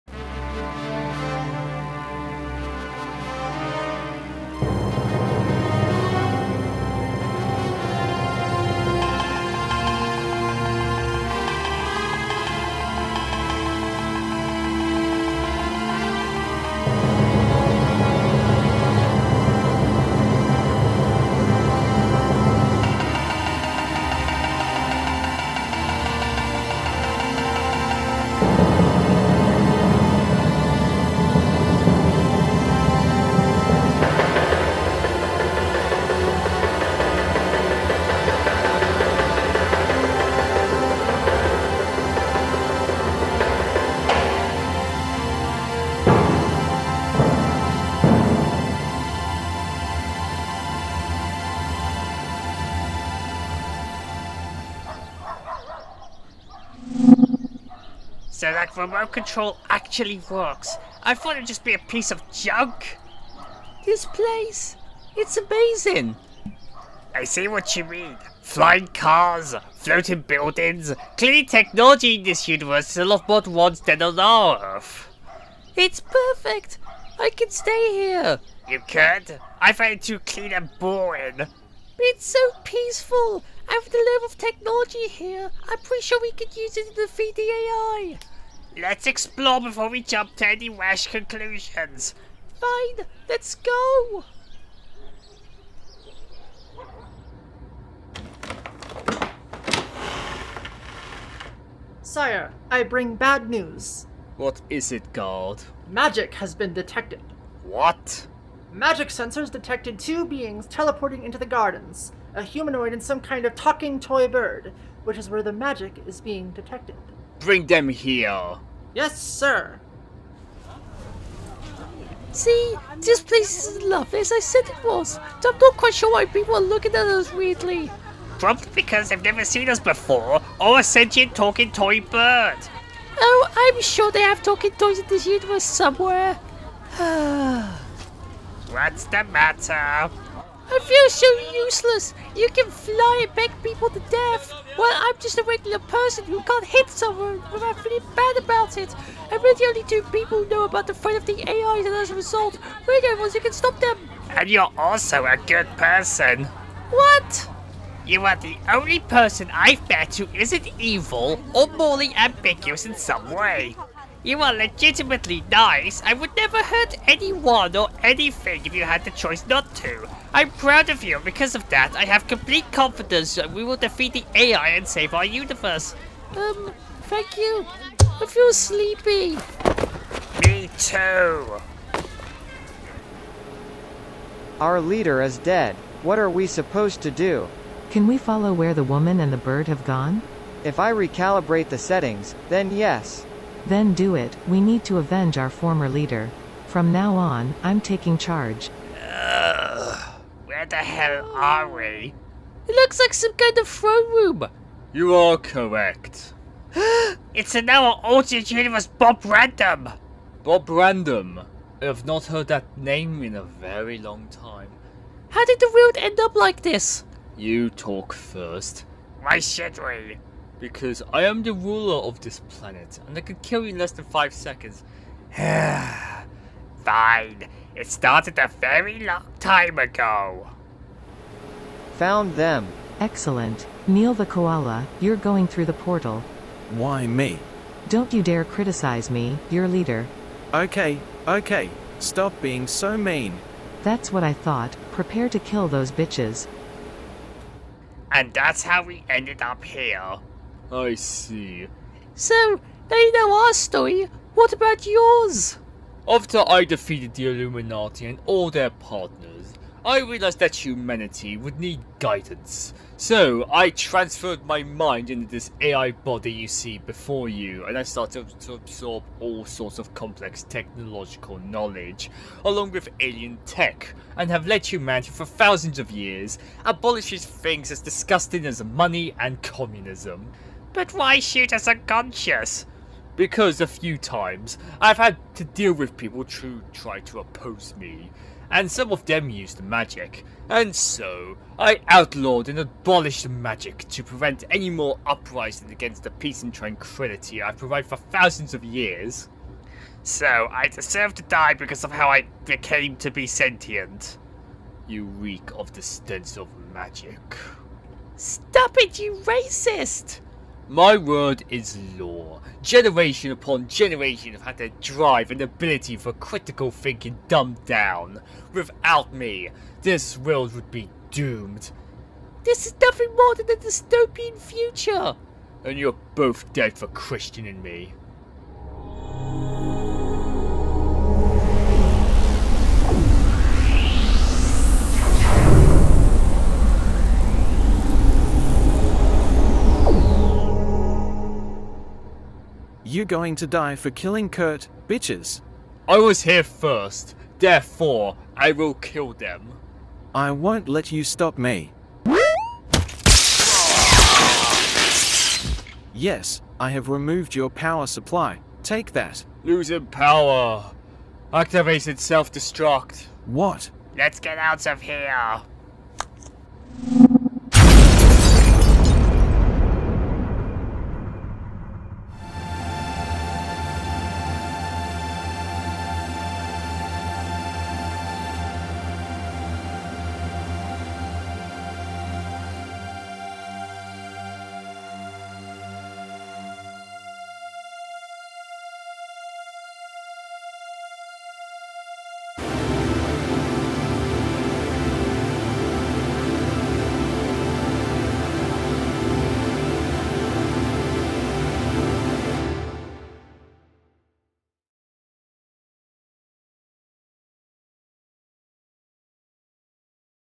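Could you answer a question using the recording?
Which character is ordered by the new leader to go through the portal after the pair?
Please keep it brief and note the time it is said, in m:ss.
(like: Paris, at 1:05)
Neil the koala, at 3:53.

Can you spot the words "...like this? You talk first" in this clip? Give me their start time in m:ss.
3:36.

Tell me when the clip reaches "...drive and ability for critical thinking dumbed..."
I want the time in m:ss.
5:14.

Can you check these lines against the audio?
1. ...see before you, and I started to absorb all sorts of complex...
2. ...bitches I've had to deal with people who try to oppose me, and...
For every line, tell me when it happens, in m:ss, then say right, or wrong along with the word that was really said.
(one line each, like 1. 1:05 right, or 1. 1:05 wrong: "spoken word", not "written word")
1. 4:26 right
2. 4:43 wrong: "times", not "bitches".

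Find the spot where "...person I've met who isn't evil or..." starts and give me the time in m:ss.
2:39.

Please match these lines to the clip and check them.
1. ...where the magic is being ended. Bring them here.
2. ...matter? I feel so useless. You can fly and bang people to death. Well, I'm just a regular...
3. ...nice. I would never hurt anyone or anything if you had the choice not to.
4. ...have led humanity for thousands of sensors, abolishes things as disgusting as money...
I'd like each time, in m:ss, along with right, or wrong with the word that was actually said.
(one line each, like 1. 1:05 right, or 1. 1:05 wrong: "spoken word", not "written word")
1. 1:55 wrong: "detected", not "ended"
2. 2:19 right
3. 2:45 right
4. 4:34 wrong: "years", not "sensors".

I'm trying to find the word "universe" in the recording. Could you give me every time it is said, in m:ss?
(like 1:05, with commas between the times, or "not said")
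1:12, 2:15, 2:55, 3:28.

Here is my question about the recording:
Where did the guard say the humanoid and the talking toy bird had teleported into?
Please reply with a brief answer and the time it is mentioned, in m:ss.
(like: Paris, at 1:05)
The gardens, at 1:51.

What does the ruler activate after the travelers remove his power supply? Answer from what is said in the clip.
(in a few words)
Self-destruct.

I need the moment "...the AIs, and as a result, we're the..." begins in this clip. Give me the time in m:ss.
2:31.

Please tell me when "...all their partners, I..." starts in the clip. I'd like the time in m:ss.
4:18.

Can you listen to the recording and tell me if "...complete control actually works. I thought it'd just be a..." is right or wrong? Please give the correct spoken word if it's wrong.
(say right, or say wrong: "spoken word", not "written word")
wrong: "remote", not "complete".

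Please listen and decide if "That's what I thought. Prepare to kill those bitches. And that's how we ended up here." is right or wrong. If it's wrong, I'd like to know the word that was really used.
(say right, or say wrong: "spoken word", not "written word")
right.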